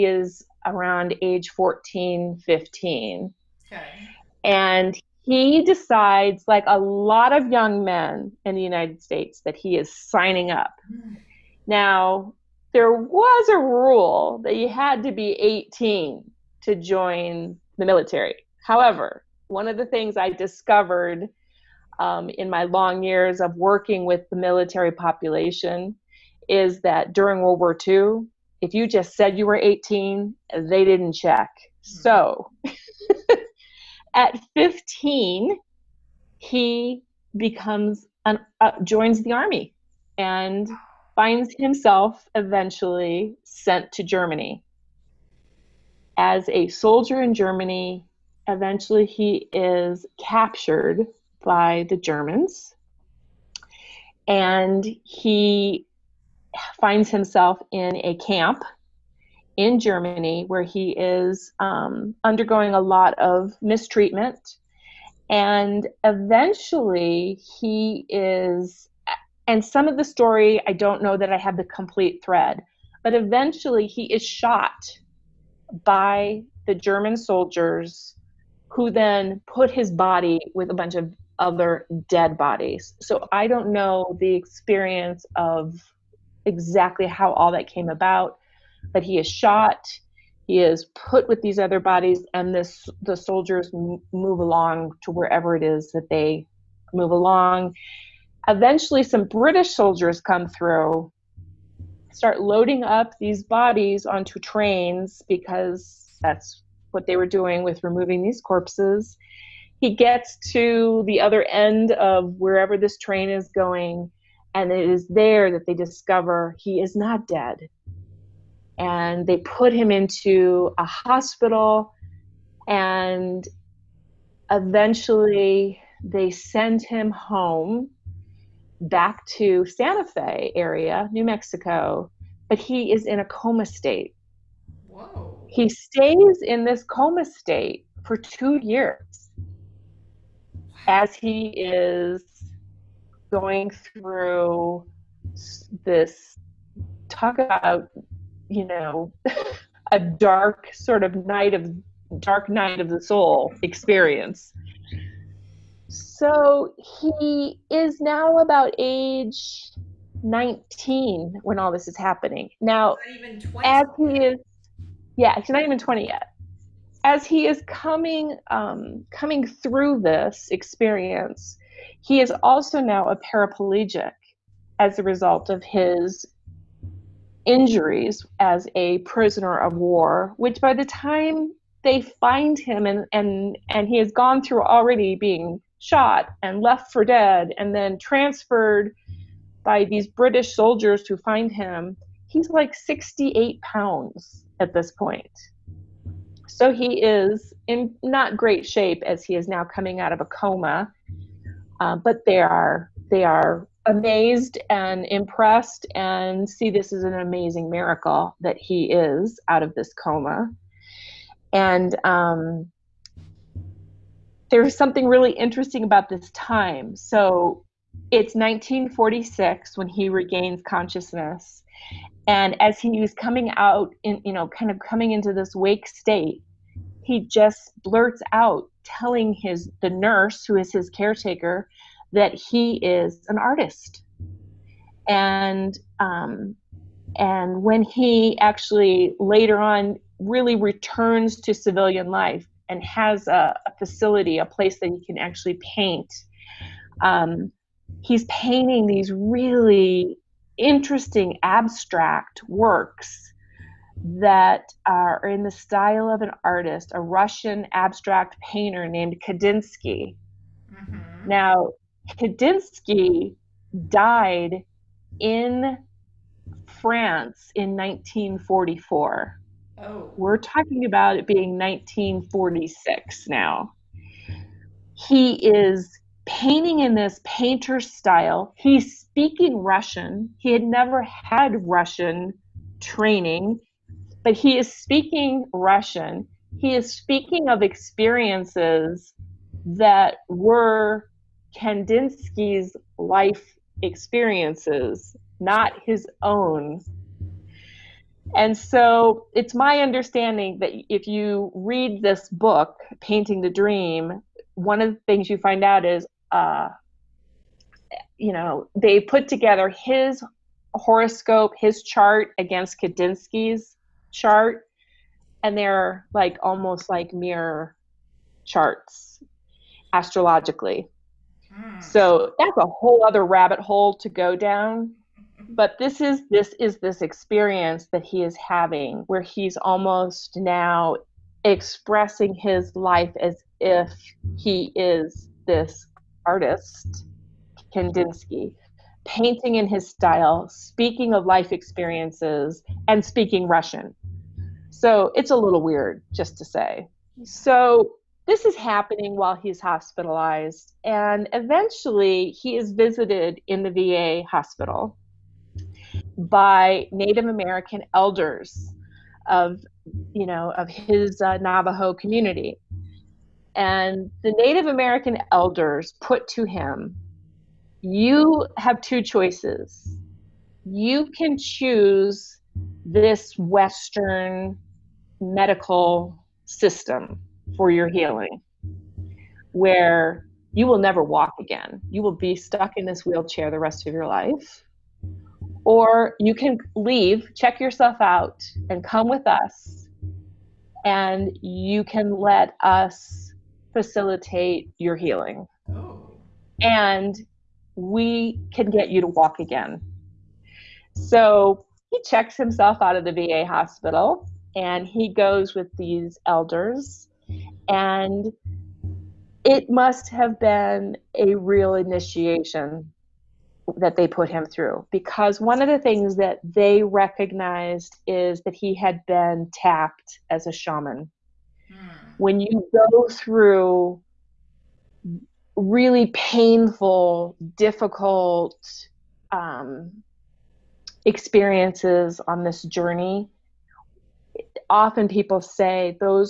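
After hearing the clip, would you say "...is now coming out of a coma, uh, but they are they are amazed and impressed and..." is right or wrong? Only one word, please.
right.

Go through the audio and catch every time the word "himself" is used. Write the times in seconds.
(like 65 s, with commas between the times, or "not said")
41 s, 57 s, 402 s.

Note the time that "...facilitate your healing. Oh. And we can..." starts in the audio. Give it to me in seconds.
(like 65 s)
393 s.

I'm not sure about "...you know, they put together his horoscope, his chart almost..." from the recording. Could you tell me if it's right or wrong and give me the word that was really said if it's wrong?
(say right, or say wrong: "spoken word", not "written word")
wrong: "against", not "almost".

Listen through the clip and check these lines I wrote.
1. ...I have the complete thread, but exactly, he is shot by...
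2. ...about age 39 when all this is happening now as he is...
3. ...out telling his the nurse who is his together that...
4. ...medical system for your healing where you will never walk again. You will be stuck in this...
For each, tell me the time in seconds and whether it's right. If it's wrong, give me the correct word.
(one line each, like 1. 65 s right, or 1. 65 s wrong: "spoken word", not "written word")
1. 71 s wrong: "eventually", not "exactly"
2. 158 s wrong: "19", not "39"
3. 228 s wrong: "caretaker", not "together"
4. 375 s right.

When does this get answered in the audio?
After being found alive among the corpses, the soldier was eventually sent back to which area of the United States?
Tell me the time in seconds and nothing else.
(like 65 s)
129 s.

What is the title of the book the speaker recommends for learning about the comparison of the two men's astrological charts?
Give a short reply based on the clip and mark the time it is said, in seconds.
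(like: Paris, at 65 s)
Painting the Dream, at 302 s.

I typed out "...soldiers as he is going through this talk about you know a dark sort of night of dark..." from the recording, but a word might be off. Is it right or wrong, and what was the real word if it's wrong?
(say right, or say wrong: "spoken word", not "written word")
wrong: "years", not "soldiers".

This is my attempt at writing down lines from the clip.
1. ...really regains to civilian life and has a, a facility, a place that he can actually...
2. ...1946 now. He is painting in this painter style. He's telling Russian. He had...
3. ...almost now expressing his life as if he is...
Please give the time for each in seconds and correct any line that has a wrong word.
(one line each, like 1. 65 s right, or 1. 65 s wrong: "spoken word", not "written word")
1. 240 s wrong: "returns", not "regains"
2. 271 s wrong: "speaking", not "telling"
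3. 329 s right.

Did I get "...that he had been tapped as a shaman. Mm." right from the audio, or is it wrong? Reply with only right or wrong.
right.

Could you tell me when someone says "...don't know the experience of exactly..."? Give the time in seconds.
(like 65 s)
83 s.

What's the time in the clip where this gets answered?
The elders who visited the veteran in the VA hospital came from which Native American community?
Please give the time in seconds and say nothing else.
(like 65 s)
361 s.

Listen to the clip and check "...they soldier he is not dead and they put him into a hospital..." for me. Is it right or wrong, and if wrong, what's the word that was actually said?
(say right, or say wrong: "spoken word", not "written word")
wrong: "discover", not "soldier".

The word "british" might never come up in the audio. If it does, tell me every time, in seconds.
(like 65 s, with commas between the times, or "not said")
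99 s, 190 s.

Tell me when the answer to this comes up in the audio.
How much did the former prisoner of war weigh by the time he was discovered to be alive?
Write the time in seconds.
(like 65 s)
192 s.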